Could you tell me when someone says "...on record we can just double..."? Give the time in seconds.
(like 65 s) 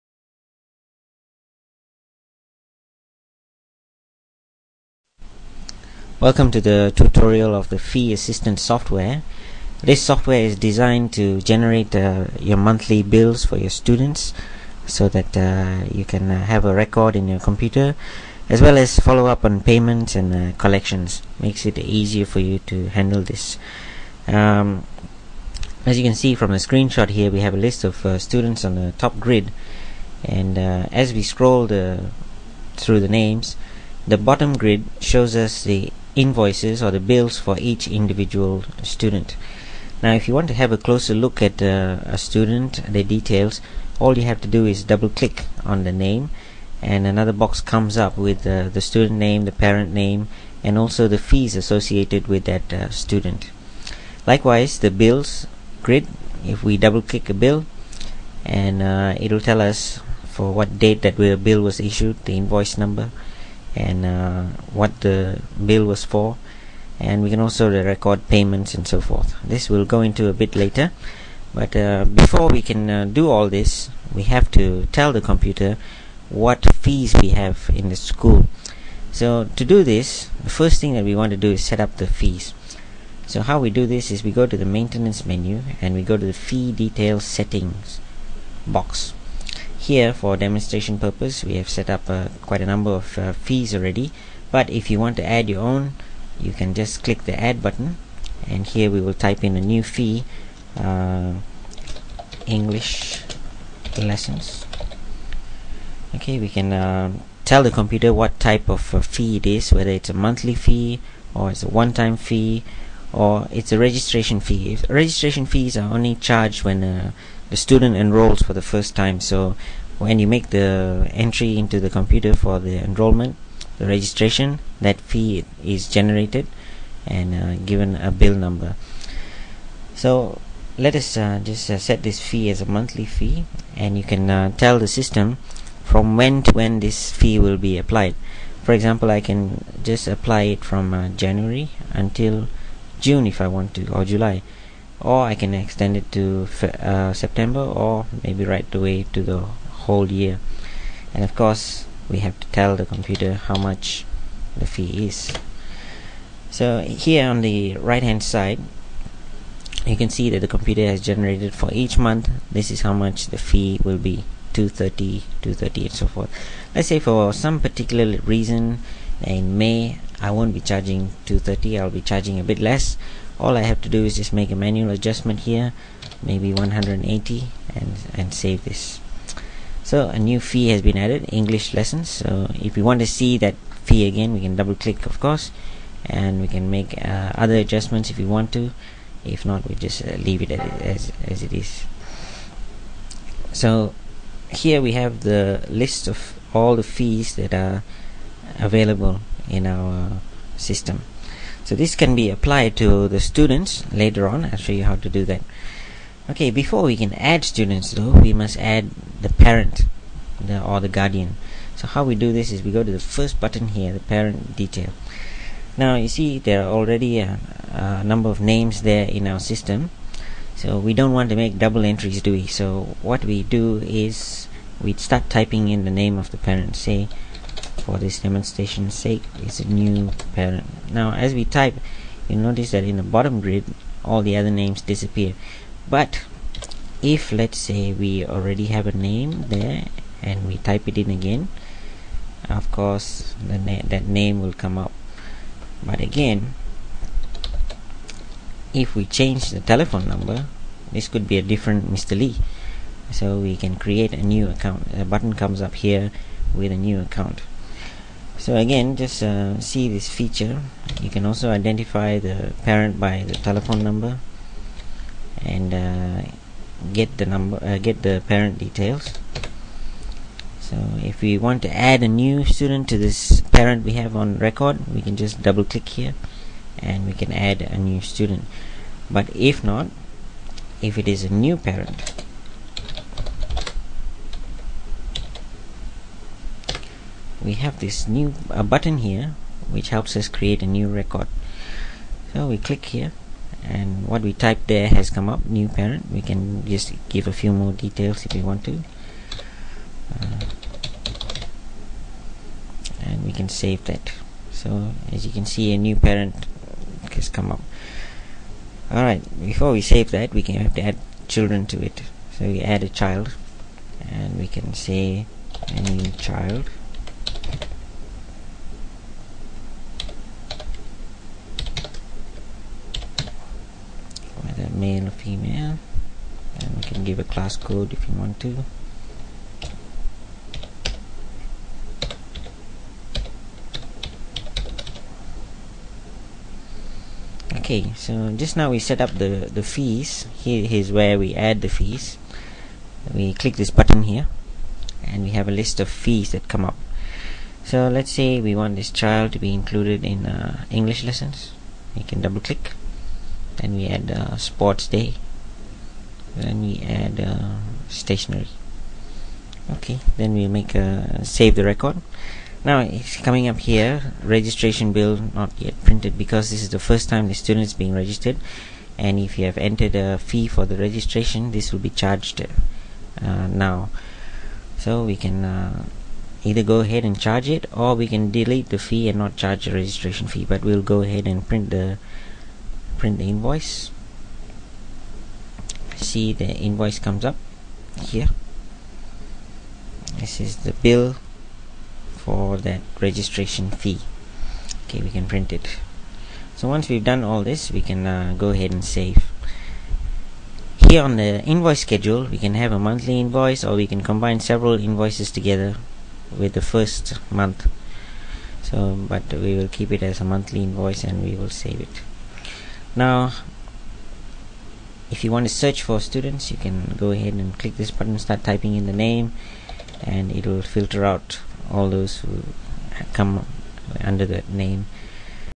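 274 s.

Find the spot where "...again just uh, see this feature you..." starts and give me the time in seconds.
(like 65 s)
258 s.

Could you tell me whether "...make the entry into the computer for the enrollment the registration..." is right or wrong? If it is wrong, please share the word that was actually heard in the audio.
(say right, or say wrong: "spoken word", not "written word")
right.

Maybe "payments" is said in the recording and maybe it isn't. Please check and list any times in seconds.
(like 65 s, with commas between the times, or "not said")
19 s, 68 s.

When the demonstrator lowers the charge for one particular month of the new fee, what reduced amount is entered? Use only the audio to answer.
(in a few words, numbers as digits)
180.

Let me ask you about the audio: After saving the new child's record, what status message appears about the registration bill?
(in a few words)
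not yet printed.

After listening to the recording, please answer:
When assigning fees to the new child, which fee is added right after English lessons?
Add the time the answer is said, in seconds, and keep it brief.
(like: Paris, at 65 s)
sports day, at 354 s.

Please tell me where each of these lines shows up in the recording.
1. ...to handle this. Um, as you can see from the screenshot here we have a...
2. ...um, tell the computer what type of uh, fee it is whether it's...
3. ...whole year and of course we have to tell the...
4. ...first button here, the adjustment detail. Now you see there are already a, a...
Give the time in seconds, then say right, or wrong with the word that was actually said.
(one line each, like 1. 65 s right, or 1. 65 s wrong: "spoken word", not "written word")
1. 22 s right
2. 106 s right
3. 149 s right
4. 212 s wrong: "parent", not "adjustment".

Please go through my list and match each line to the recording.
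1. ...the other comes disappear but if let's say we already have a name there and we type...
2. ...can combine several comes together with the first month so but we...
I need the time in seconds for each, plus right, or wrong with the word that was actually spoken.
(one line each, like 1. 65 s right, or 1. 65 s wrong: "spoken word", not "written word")
1. 234 s wrong: "names", not "comes"
2. 403 s wrong: "invoices", not "comes".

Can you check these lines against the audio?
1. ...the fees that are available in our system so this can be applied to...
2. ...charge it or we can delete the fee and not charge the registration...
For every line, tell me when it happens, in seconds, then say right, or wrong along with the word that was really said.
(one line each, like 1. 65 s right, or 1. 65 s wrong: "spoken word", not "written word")
1. 196 s right
2. 377 s right.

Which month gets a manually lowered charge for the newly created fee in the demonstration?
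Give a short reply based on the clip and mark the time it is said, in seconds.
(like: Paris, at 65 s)
May, at 169 s.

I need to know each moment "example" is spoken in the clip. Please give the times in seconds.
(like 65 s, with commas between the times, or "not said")
138 s.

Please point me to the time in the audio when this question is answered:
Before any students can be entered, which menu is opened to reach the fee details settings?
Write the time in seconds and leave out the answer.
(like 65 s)
84 s.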